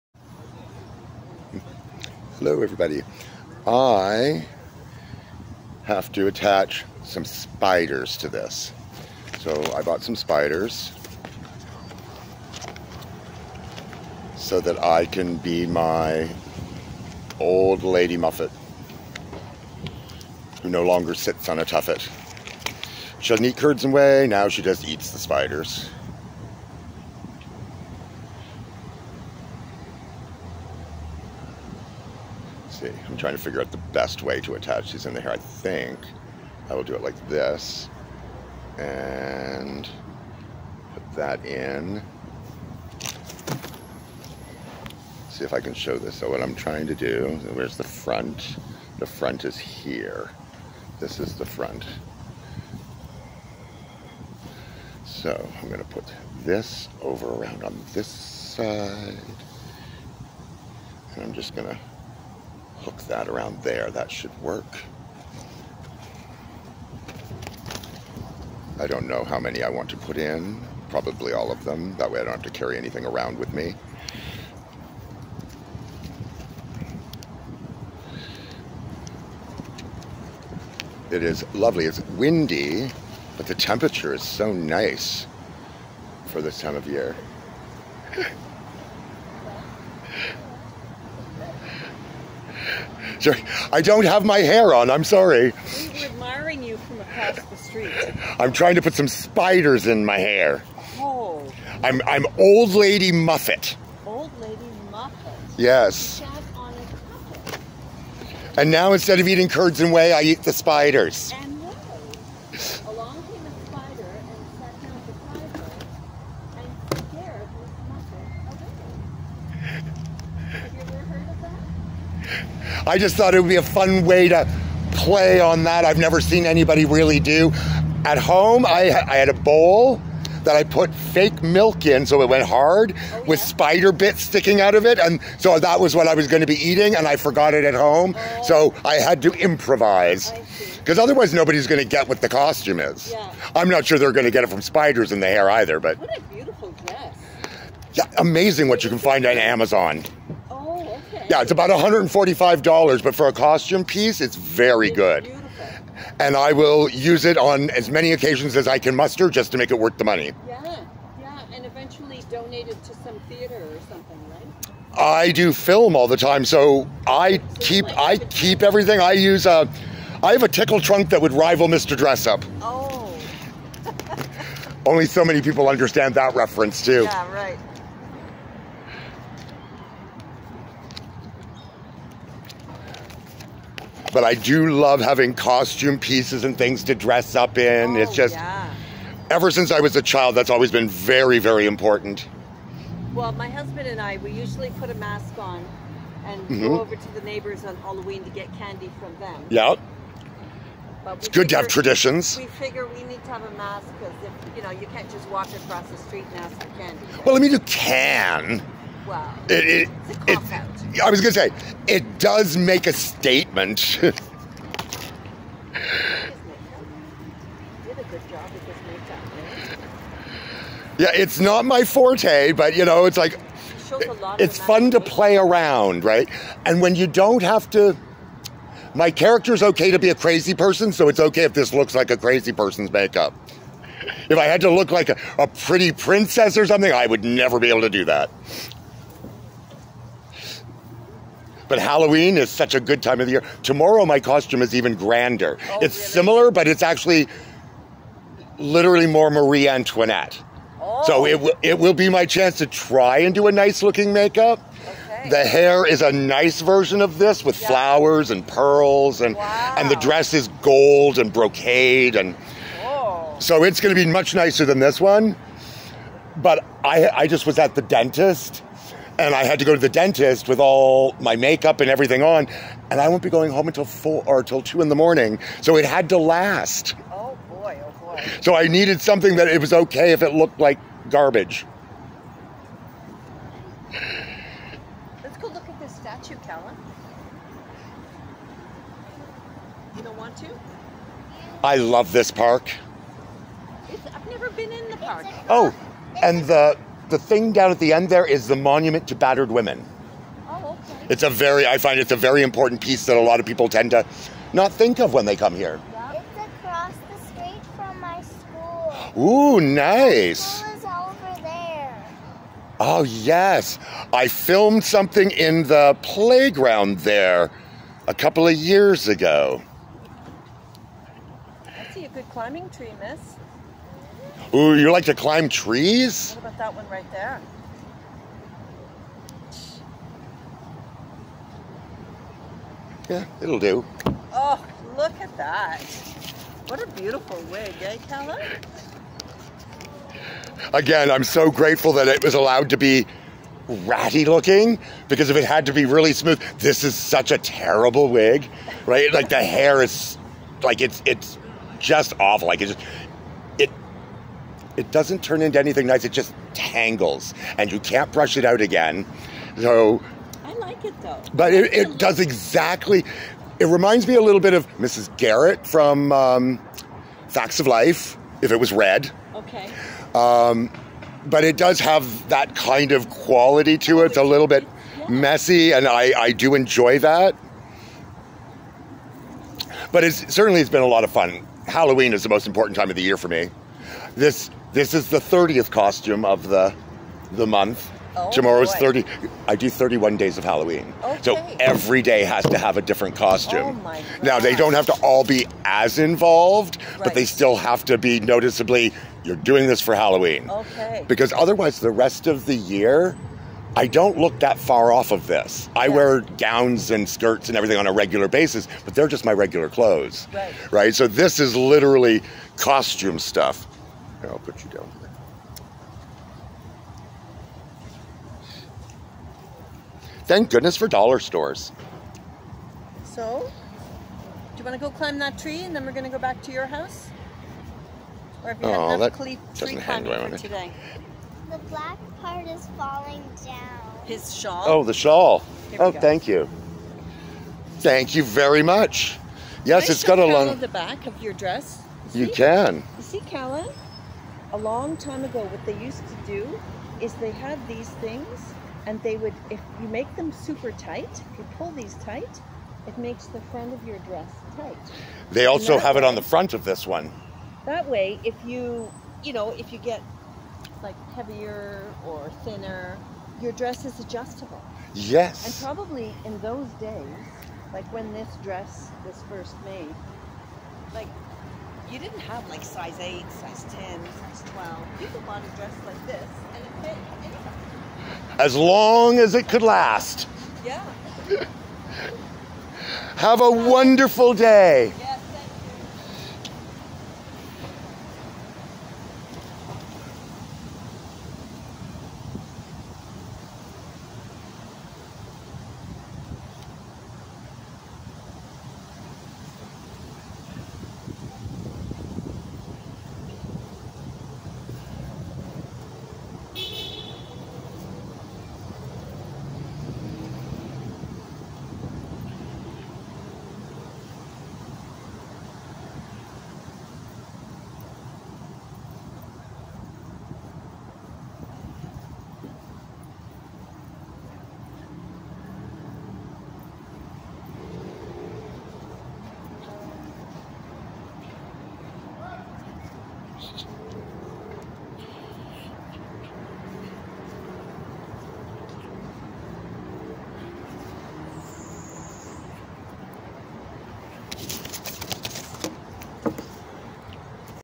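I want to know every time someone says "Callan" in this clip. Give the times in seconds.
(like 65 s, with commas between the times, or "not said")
286 s, 443 s.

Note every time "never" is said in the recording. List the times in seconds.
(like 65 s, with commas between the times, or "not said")
125 s, 237 s, 294 s.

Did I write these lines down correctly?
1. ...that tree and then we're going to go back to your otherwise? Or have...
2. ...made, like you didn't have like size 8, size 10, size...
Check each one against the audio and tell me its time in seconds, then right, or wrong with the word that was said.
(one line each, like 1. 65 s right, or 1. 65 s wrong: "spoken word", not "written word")
1. 425 s wrong: "house", not "otherwise"
2. 469 s right.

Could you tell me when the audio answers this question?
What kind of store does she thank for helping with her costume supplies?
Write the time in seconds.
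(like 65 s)
420 s.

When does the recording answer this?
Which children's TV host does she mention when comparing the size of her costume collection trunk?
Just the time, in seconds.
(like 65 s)
171 s.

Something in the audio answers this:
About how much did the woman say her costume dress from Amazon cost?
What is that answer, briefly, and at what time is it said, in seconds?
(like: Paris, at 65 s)
$145, at 151 s.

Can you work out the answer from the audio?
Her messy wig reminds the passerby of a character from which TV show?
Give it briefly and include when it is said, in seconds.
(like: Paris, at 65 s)
Facts of Life, at 367 s.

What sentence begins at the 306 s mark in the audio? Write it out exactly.
It's across the street from my school.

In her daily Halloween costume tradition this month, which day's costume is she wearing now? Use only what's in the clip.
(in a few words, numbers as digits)
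30th.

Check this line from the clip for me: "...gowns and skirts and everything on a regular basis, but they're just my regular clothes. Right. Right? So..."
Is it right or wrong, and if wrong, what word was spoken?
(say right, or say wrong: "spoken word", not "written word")
right.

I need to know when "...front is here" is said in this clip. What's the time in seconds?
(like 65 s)
49 s.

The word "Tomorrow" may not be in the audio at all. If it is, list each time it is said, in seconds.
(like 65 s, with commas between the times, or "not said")
243 s, 388 s.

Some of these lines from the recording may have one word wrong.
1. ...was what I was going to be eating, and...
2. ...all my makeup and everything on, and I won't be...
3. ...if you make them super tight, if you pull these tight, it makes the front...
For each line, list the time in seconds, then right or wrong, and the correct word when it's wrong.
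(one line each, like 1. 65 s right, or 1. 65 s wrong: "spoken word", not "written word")
1. 135 s right
2. 270 s right
3. 449 s right.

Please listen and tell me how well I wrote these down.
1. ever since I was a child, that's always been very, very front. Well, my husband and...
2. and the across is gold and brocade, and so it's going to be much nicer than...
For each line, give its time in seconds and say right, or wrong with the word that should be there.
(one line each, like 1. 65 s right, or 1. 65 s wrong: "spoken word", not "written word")
1. 189 s wrong: "important", not "front"
2. 259 s wrong: "dress", not "across".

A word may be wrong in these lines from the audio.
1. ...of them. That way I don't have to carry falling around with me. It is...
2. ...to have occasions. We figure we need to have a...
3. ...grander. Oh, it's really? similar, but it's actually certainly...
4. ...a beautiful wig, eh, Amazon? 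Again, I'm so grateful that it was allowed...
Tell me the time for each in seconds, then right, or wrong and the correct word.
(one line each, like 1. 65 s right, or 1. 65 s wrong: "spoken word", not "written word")
1. 71 s wrong: "anything", not "falling"
2. 201 s wrong: "traditions", not "occasions"
3. 244 s wrong: "literally", not "certainly"
4. 336 s wrong: "Keller", not "Amazon".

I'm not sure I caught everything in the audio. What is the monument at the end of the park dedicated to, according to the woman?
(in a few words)
battered women.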